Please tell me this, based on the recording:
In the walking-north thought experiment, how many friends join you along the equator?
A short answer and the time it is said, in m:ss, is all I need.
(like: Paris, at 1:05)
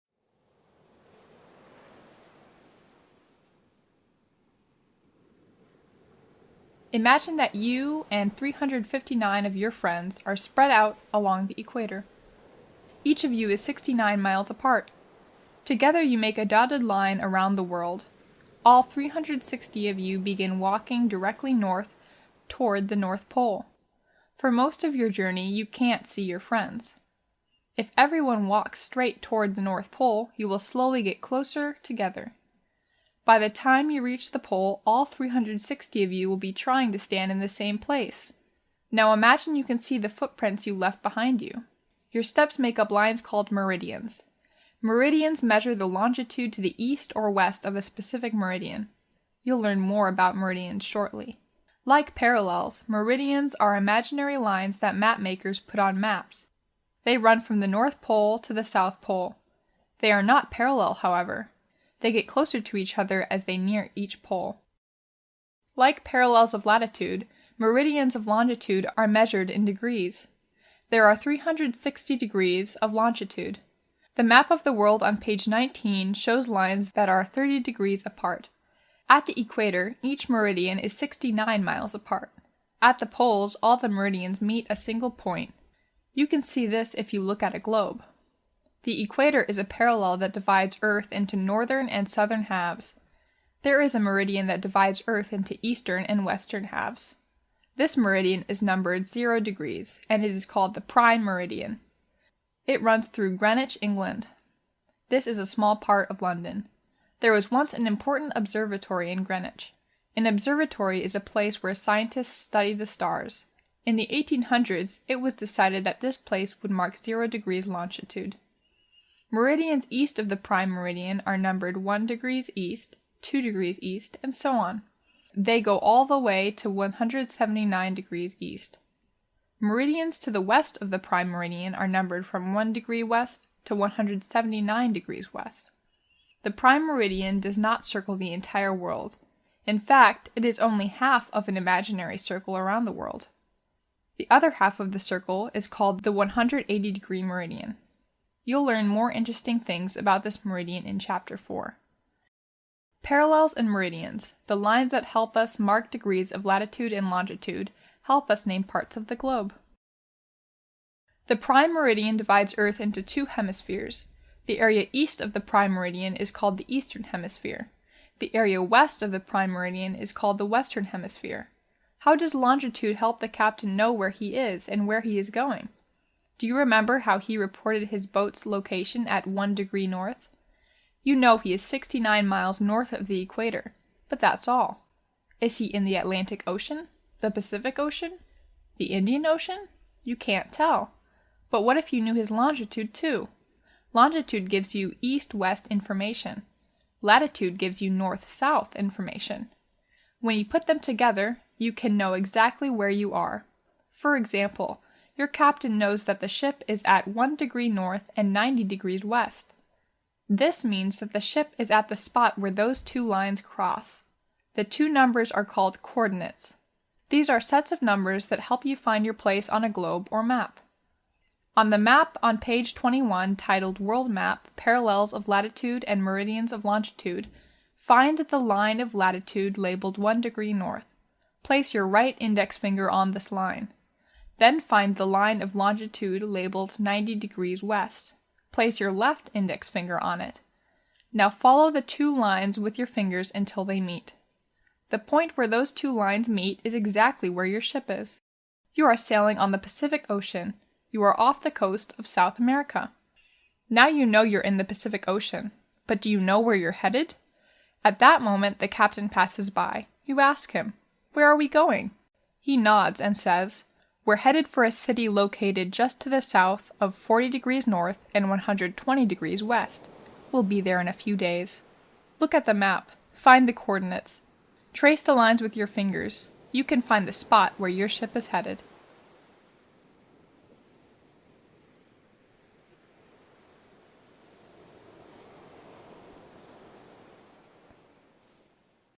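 359, at 0:08.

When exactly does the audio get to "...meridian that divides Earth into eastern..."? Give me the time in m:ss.
1:33.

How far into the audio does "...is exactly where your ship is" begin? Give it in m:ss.
4:06.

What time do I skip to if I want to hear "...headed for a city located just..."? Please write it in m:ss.
4:24.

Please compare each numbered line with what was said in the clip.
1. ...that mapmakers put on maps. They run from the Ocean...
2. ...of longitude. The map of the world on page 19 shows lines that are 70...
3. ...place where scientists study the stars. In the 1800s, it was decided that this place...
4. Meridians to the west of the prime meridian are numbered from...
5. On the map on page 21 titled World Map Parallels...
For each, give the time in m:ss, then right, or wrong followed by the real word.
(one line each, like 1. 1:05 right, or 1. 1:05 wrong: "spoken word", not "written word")
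1. 0:54 wrong: "North", not "Ocean"
2. 1:12 wrong: "30", not "70"
3. 1:51 right
4. 2:09 right
5. 3:41 right.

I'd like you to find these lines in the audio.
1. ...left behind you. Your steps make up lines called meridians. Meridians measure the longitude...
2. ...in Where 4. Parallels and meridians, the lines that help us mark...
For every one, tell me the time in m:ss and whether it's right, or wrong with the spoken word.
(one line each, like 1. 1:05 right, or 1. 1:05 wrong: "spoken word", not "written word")
1. 0:40 right
2. 2:30 wrong: "Chapter", not "Where".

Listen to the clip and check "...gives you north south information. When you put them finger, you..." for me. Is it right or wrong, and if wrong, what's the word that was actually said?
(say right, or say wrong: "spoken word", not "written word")
wrong: "together", not "finger".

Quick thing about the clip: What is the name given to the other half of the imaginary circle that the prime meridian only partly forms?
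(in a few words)
180 degree meridian.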